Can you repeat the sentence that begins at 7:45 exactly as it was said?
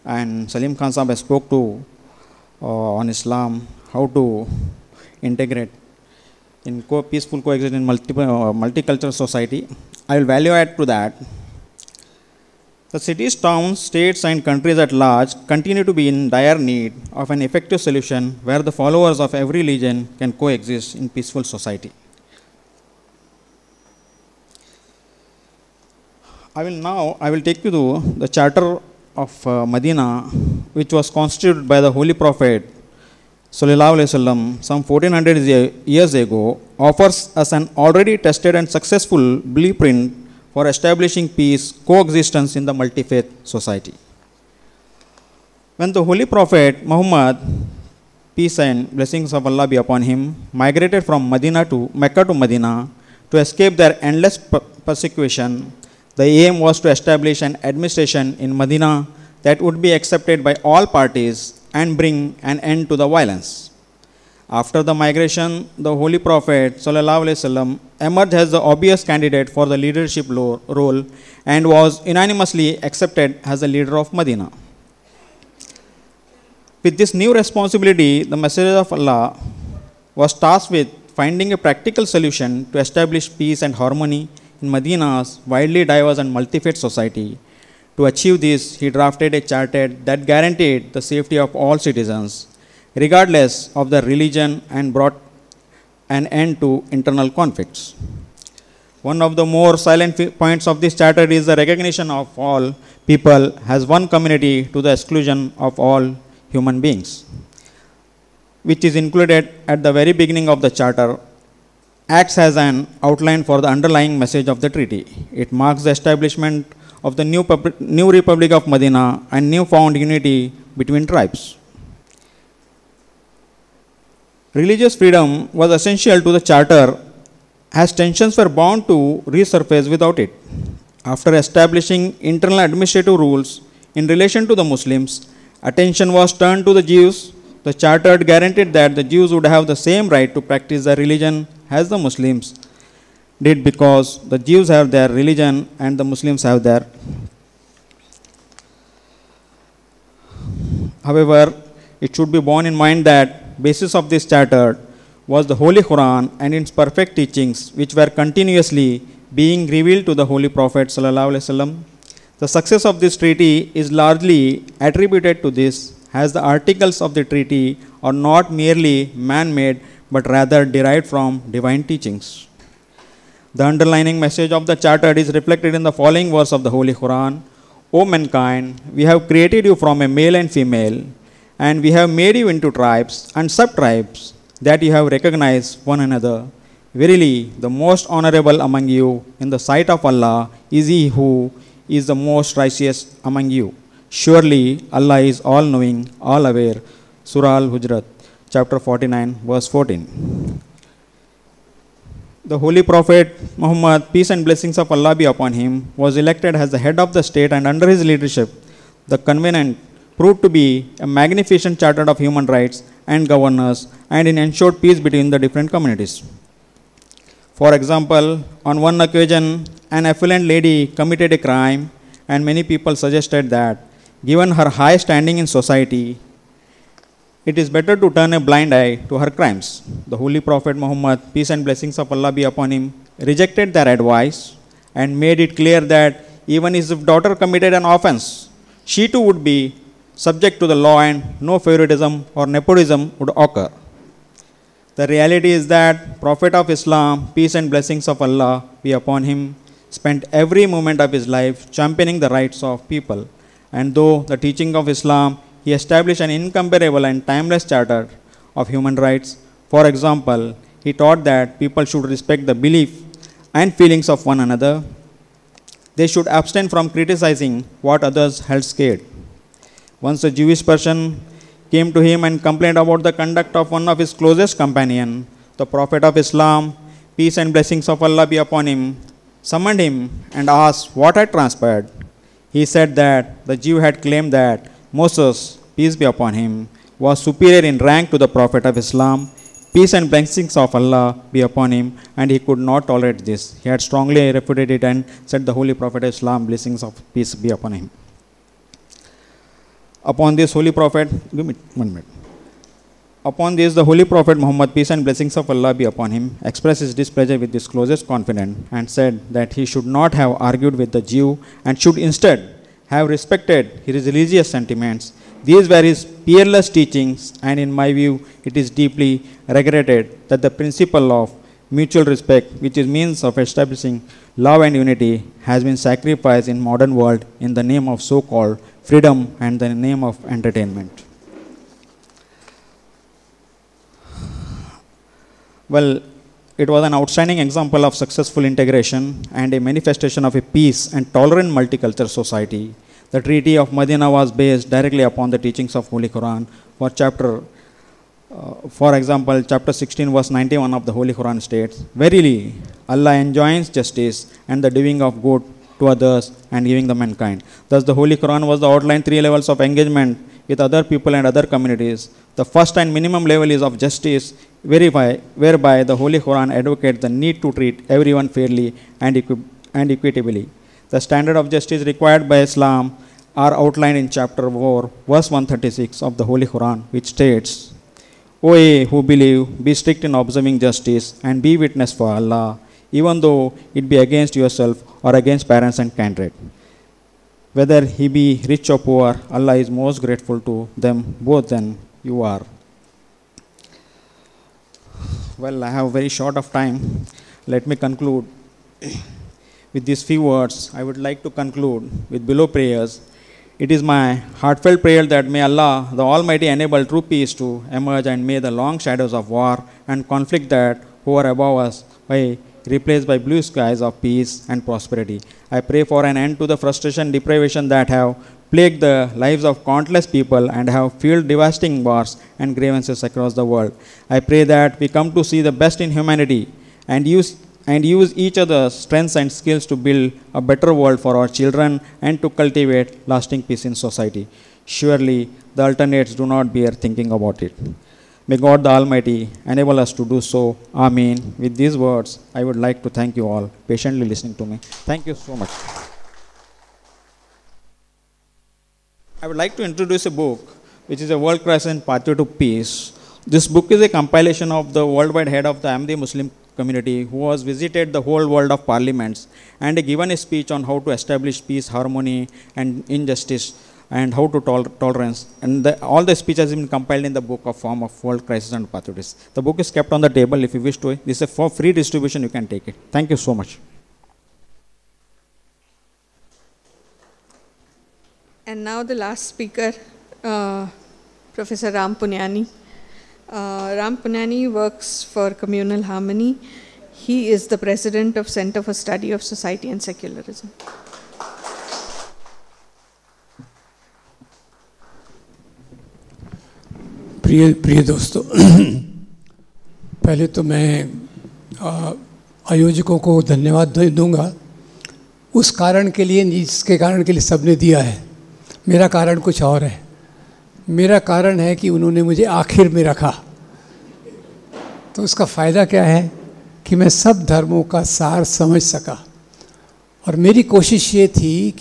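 And the, all the speech has been compiled in the book of form of World Crisis and Opportunities.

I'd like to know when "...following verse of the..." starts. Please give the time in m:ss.
2:56.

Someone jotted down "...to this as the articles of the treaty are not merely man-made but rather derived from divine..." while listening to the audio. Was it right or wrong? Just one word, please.
right.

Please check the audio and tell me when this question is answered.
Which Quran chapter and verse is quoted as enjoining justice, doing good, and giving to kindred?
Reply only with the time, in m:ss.
5:49.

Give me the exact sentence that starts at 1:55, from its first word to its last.
It marks the establishment of the new, new Republic of Medina and newfound unity between tribes.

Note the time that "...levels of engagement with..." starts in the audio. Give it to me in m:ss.
5:59.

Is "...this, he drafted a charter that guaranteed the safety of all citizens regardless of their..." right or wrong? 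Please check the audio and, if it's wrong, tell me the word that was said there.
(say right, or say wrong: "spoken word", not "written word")
right.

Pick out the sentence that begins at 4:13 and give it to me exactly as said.
And though the teaching of Islam, he established an incomparable and timeless charter of human rights.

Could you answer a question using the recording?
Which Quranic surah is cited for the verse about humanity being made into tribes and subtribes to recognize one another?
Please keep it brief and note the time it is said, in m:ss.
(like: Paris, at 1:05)
Surah Al Hujrat, at 3:17.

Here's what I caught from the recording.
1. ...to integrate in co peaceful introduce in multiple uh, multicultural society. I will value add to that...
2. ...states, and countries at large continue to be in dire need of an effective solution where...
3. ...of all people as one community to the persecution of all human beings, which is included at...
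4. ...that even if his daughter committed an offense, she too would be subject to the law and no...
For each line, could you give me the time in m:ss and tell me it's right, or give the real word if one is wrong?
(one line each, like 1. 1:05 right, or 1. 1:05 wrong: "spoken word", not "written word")
1. 0:04 wrong: "coexistence", not "introduce"
2. 0:13 right
3. 1:42 wrong: "exclusion", not "persecution"
4. 3:55 right.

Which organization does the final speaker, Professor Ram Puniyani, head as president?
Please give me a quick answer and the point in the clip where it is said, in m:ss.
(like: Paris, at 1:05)
Center for Study of Society and Secularism, at 8:08.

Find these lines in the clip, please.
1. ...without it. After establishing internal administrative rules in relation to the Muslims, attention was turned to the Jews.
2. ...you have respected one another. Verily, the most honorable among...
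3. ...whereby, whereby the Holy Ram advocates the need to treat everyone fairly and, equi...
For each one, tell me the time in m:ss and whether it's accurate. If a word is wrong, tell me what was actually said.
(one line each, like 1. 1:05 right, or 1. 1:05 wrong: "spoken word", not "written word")
1. 2:09 right
2. 3:04 wrong: "recognized", not "respected"
3. 6:04 wrong: "Quran", not "Ram".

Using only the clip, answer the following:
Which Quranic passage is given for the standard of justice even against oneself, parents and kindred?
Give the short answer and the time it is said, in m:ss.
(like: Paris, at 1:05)
chapter 4, verse 136, at 6:14.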